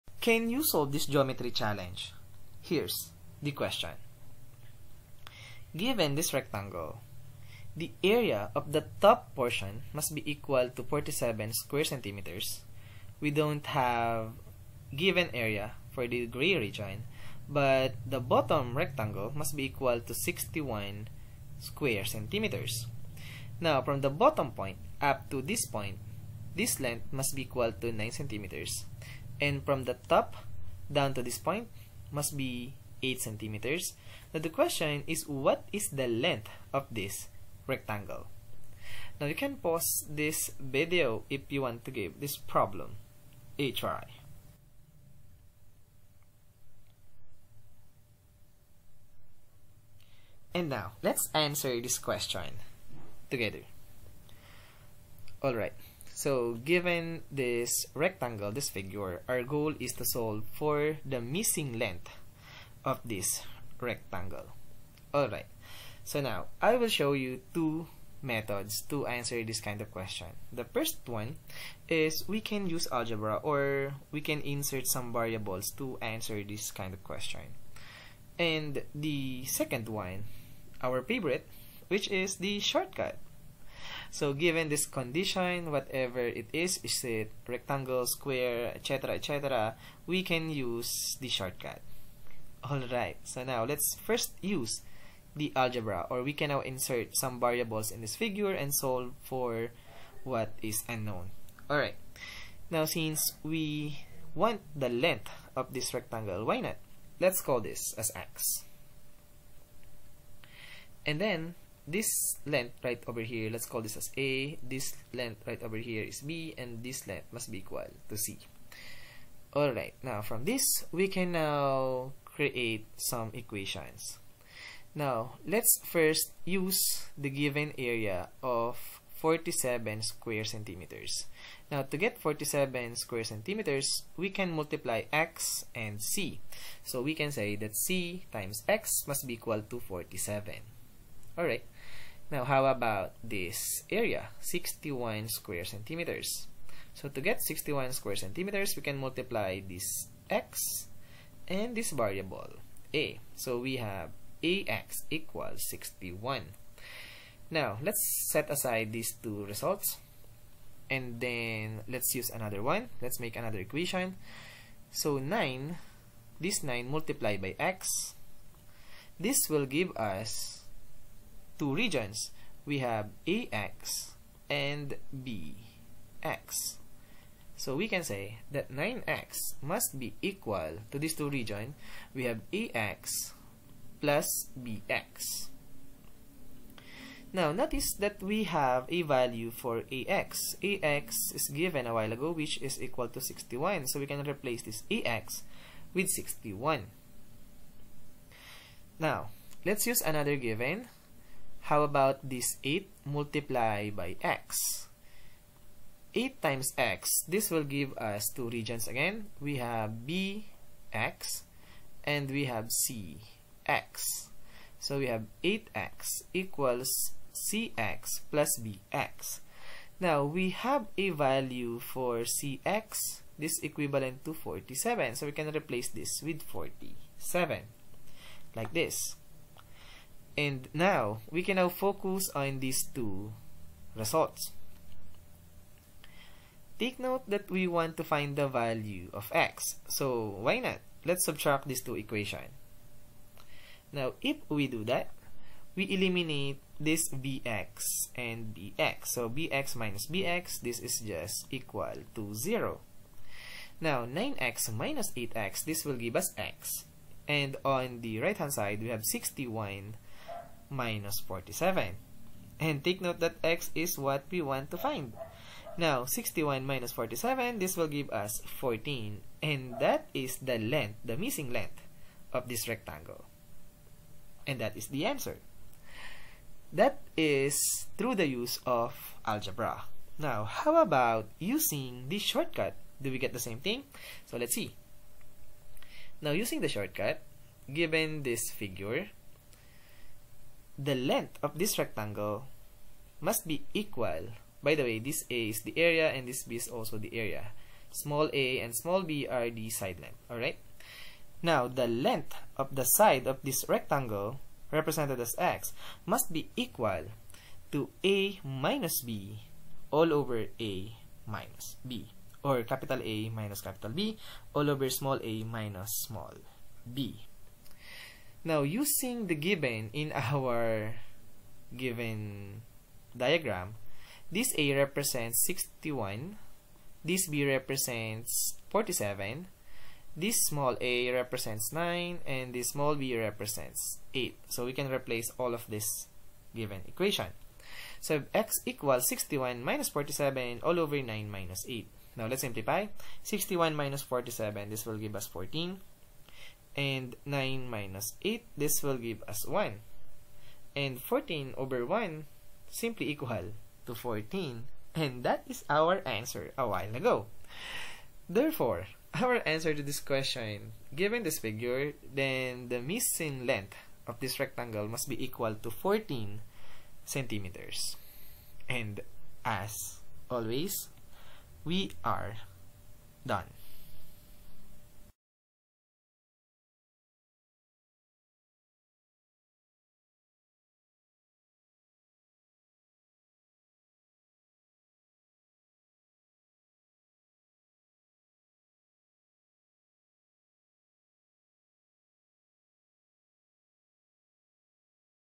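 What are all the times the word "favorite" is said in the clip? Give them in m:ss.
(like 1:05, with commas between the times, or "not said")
1:21.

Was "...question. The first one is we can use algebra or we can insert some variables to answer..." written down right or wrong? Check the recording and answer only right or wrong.
right.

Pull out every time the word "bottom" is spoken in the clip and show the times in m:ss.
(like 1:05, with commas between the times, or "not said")
0:18, 0:24.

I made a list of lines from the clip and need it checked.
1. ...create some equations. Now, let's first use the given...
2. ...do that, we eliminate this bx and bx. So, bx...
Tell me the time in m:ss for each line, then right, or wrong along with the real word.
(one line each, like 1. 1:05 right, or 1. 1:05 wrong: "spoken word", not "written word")
1. 2:02 right
2. 4:04 right.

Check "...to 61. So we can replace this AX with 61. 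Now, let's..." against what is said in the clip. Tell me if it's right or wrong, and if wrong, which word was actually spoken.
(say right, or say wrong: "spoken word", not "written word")
right.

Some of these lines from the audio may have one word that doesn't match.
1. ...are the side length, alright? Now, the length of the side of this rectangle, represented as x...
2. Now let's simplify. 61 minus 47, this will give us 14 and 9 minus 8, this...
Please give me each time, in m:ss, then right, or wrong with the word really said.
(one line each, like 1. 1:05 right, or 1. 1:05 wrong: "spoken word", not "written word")
1. 4:59 right
2. 5:42 right.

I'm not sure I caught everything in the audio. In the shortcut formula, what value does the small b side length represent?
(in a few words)
8.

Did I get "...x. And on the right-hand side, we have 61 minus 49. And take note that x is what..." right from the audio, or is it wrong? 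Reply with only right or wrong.
wrong.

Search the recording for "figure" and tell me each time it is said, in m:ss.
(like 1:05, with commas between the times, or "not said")
0:58, 1:38, 4:48, 6:01.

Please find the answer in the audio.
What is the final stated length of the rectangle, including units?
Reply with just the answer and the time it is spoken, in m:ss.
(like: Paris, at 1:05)
14 centimeters, at 6:05.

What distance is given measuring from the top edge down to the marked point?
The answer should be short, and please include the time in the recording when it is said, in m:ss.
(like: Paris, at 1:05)
8 centimeters, at 0:33.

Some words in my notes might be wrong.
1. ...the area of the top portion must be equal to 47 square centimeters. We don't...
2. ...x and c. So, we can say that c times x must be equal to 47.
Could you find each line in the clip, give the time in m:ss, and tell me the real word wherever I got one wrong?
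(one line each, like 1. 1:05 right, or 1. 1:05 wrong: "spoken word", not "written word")
1. 0:07 right
2. 2:15 right.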